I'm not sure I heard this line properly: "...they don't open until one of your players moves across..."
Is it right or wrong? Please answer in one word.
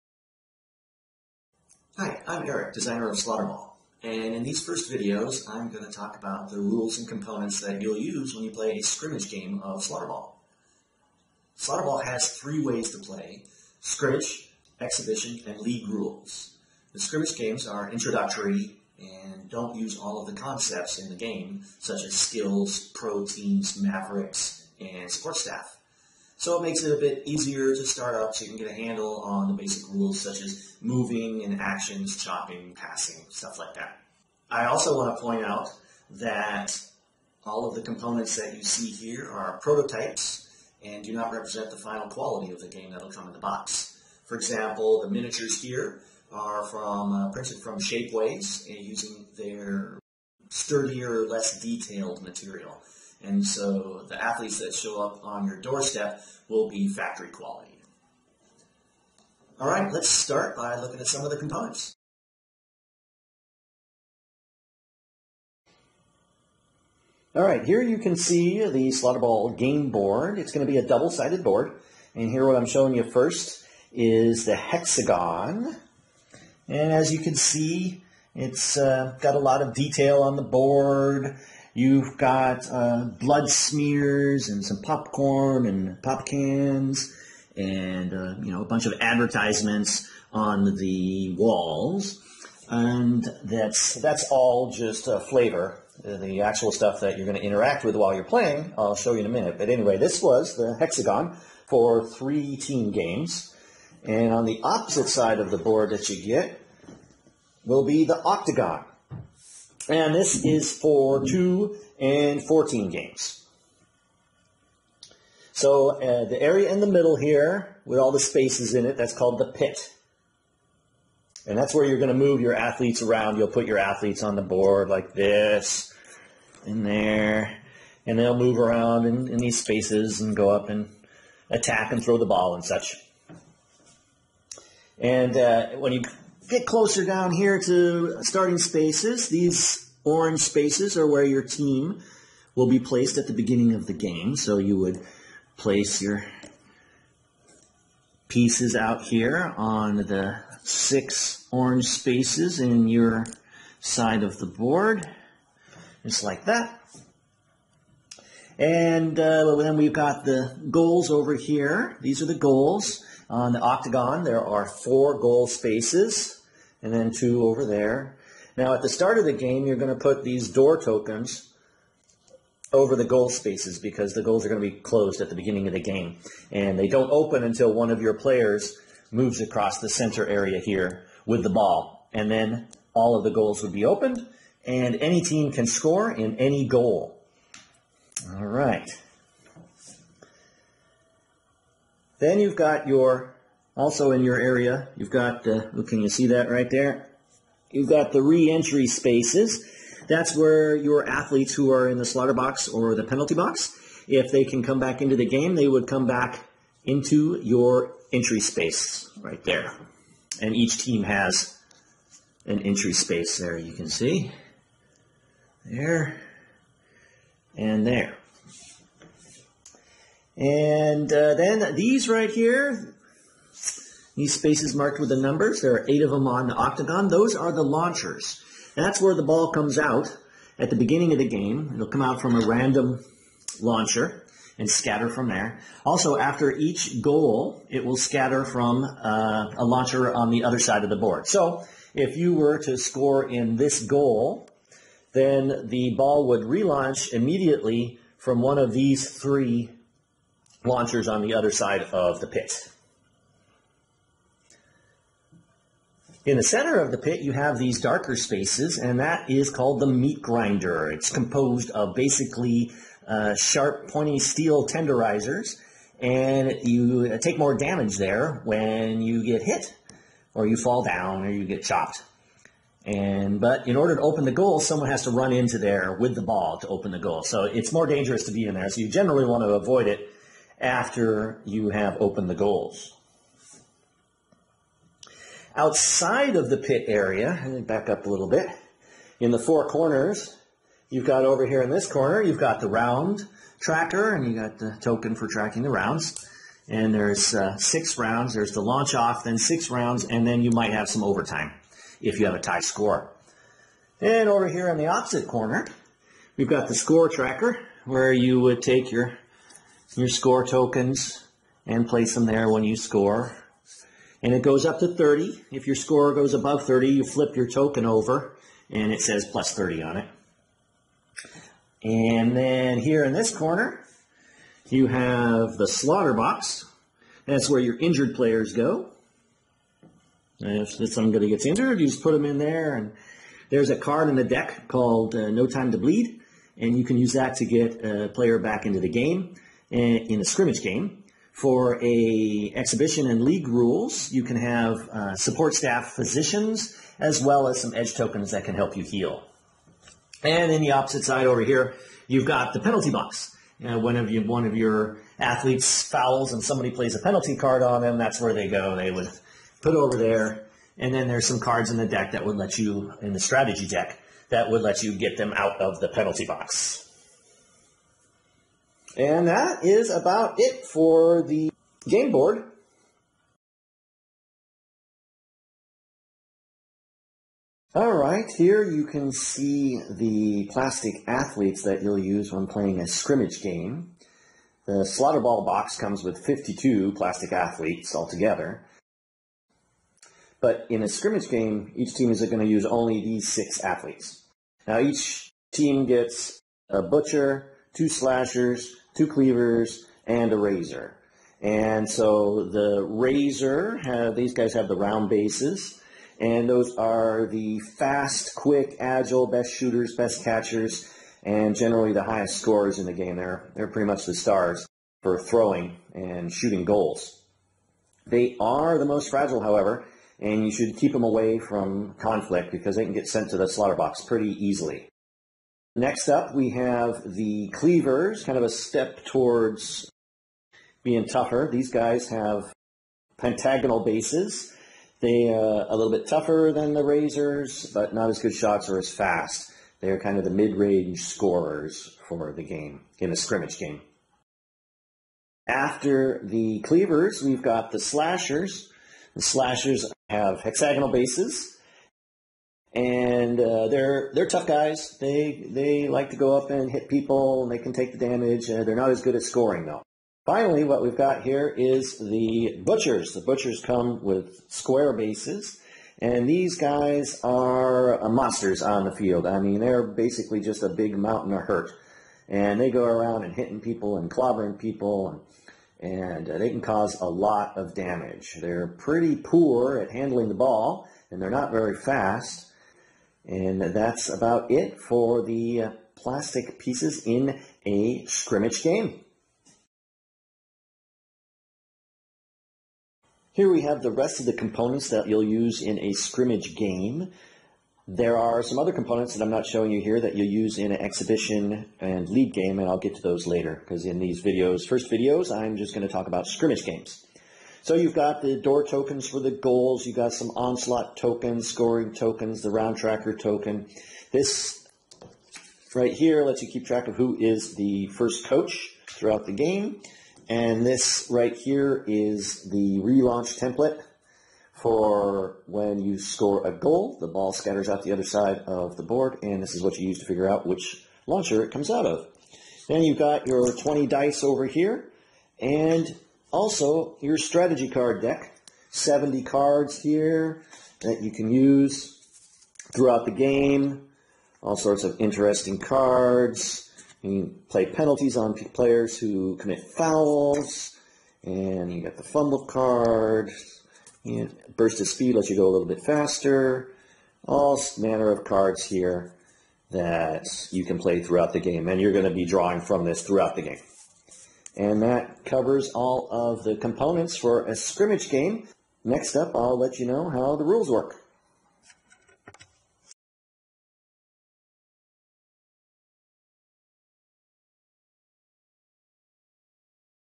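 right.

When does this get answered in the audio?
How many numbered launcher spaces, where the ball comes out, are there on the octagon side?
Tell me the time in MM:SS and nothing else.
03:45.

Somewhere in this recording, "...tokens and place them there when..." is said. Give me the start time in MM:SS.
05:10.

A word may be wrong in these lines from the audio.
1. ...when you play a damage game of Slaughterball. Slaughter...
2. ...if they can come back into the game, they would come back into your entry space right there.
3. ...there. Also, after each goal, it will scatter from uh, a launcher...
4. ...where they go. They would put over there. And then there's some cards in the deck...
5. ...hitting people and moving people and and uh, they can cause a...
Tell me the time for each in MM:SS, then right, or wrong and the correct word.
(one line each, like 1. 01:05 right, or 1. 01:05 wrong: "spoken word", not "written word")
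1. 00:08 wrong: "scrimmage", not "damage"
2. 03:24 right
3. 03:55 right
4. 05:58 right
5. 07:53 wrong: "clobbering", not "moving".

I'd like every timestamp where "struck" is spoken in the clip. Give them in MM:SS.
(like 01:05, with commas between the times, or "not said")
not said.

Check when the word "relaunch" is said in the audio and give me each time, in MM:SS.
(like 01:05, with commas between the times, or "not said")
04:06, 08:42.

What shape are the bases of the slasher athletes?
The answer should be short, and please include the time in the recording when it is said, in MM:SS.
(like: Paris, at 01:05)
hexagonal, at 07:30.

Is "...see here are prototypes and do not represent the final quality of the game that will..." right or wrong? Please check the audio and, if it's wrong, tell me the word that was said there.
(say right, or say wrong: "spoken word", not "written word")
right.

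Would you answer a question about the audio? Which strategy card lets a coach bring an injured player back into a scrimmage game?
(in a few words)
No Time to Bleed.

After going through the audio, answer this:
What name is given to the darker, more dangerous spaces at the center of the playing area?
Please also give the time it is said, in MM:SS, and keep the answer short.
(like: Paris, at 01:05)
meat grinder, at 04:19.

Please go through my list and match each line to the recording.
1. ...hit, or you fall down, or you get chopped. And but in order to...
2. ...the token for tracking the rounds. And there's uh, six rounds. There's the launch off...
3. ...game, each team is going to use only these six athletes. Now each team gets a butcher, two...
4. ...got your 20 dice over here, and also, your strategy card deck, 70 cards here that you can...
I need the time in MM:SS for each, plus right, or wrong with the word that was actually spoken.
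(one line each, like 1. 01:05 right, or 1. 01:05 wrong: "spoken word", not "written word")
1. 04:29 right
2. 04:54 right
3. 06:31 right
4. 08:52 right.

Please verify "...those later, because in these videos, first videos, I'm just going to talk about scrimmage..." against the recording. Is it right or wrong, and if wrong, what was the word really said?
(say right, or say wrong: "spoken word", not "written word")
right.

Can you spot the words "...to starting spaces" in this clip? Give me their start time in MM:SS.
02:17.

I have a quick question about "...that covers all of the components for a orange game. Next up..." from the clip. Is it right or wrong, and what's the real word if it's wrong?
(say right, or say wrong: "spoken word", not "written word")
wrong: "scrimmage", not "orange".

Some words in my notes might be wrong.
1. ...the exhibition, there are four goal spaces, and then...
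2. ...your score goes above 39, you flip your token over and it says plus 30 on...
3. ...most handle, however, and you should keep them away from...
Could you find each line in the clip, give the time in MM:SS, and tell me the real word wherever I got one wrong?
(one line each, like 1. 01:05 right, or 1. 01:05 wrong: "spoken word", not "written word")
1. 02:43 wrong: "octagon", not "exhibition"
2. 05:15 wrong: "30", not "39"
3. 06:58 wrong: "fragile", not "handle".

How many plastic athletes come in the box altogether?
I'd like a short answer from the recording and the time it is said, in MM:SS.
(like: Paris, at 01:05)
52, at 06:26.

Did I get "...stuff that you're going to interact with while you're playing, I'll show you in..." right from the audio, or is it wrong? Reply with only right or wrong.
right.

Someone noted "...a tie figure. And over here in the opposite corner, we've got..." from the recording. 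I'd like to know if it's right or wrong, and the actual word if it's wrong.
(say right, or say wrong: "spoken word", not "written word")
wrong: "score", not "figure".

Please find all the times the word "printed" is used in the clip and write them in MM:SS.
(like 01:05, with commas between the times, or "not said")
00:47.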